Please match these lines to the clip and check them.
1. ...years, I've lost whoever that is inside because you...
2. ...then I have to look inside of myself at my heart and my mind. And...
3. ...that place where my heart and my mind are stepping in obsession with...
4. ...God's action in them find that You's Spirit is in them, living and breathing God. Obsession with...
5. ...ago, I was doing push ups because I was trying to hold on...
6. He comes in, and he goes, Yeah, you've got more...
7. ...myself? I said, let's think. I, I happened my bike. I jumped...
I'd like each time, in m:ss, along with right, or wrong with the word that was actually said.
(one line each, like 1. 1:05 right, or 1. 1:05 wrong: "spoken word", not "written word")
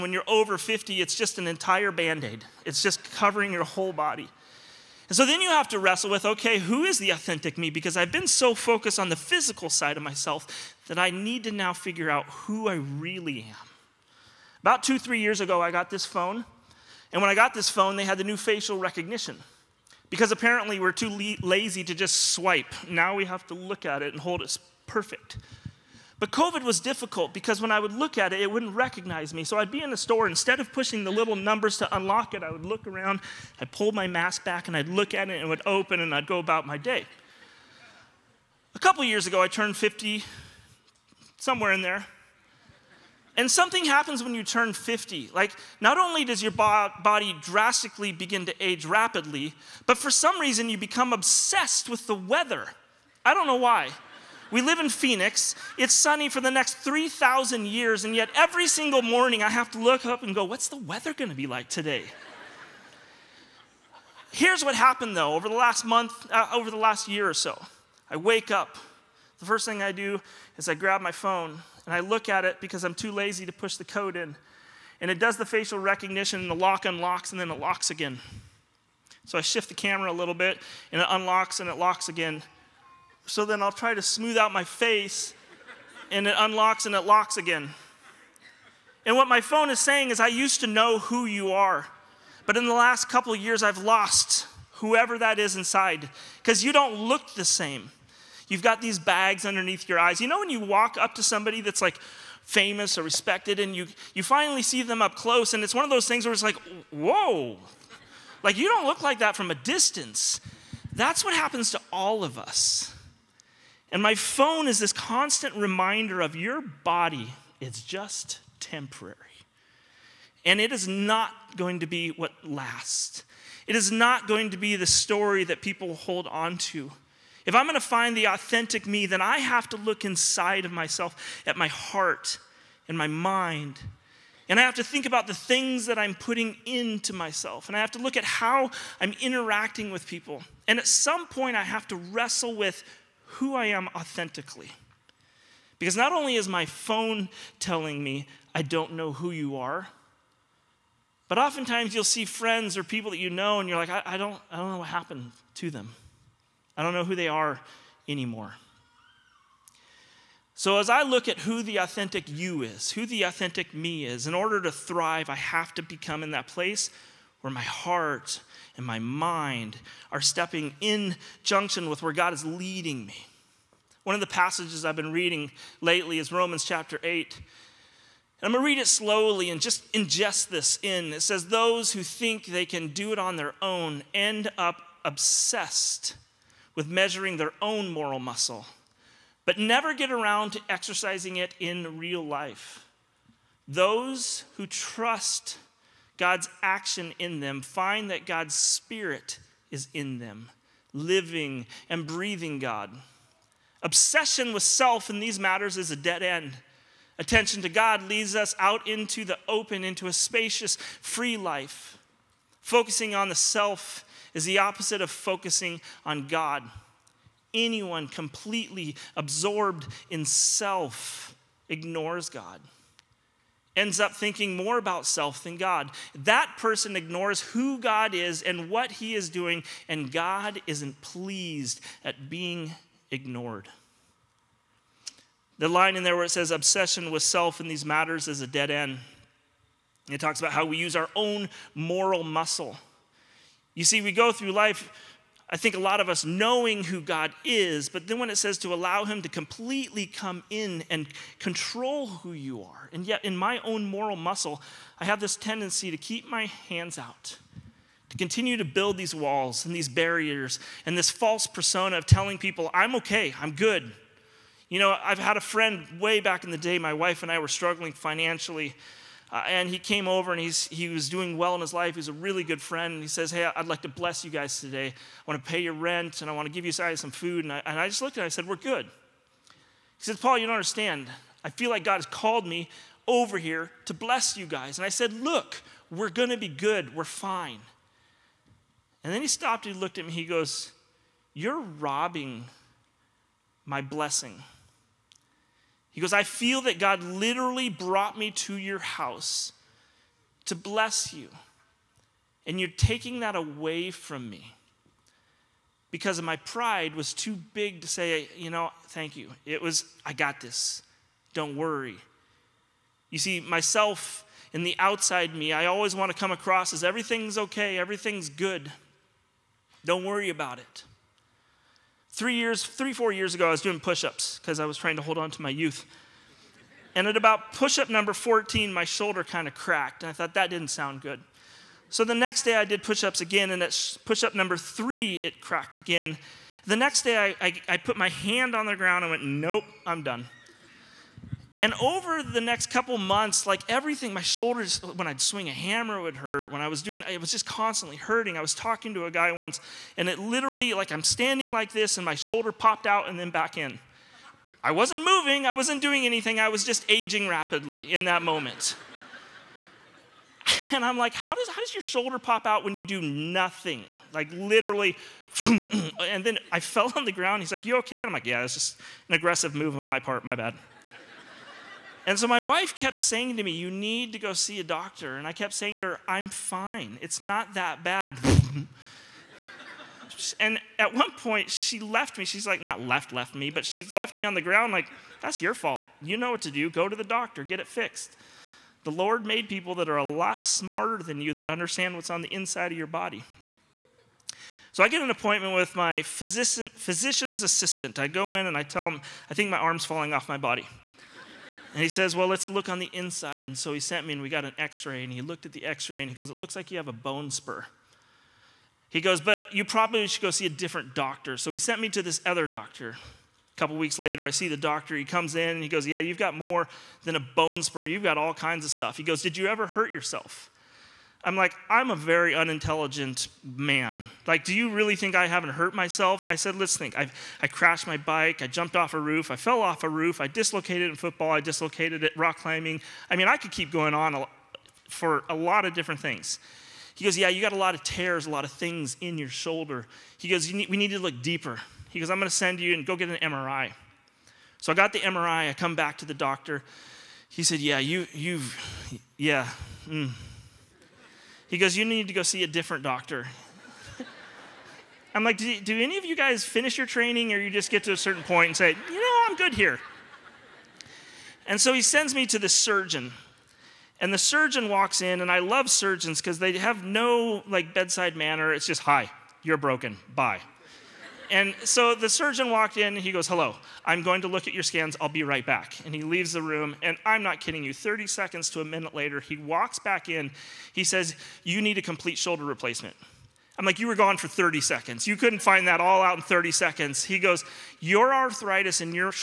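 1. 1:33 right
2. 2:09 right
3. 2:46 wrong: "junction", not "obsession"
4. 3:16 wrong: "God", not "You"
5. 5:23 right
6. 6:54 right
7. 7:05 wrong: "crashed", not "happened".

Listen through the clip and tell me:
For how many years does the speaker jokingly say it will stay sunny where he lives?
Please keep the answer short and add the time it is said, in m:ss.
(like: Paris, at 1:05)
3,000, at 0:56.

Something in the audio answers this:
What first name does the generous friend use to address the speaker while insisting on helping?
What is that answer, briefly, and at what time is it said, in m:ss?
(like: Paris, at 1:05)
Paul, at 4:40.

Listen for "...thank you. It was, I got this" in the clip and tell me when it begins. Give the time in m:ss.
5:08.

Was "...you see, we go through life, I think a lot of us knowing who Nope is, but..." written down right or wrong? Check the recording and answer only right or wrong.
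wrong.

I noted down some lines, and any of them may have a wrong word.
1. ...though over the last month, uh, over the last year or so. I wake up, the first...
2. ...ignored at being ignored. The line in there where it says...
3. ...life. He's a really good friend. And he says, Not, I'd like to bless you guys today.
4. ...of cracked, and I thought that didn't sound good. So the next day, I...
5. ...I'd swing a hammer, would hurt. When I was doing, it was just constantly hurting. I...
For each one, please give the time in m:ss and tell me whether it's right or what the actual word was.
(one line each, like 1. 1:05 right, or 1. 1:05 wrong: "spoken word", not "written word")
1. 1:05 right
2. 3:51 wrong: "pleased", not "ignored"
3. 4:31 wrong: "Hey", not "Not"
4. 5:29 right
5. 5:45 right.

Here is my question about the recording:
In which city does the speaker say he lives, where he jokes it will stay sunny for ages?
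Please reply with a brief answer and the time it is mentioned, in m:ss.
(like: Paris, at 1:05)
Phoenix, at 0:54.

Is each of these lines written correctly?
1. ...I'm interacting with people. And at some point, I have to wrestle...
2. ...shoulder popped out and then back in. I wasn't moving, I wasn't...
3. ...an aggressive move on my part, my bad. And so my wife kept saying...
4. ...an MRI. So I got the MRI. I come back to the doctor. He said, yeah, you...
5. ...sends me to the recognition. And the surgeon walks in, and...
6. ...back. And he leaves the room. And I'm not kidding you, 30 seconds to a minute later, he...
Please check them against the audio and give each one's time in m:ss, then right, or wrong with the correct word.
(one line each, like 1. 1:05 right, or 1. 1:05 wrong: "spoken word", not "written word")
1. 2:19 right
2. 5:52 right
3. 6:09 right
4. 7:23 right
5. 7:41 wrong: "surgeon", not "recognition"
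6. 7:55 right.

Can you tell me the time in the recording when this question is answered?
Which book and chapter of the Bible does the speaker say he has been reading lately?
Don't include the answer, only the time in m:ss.
2:56.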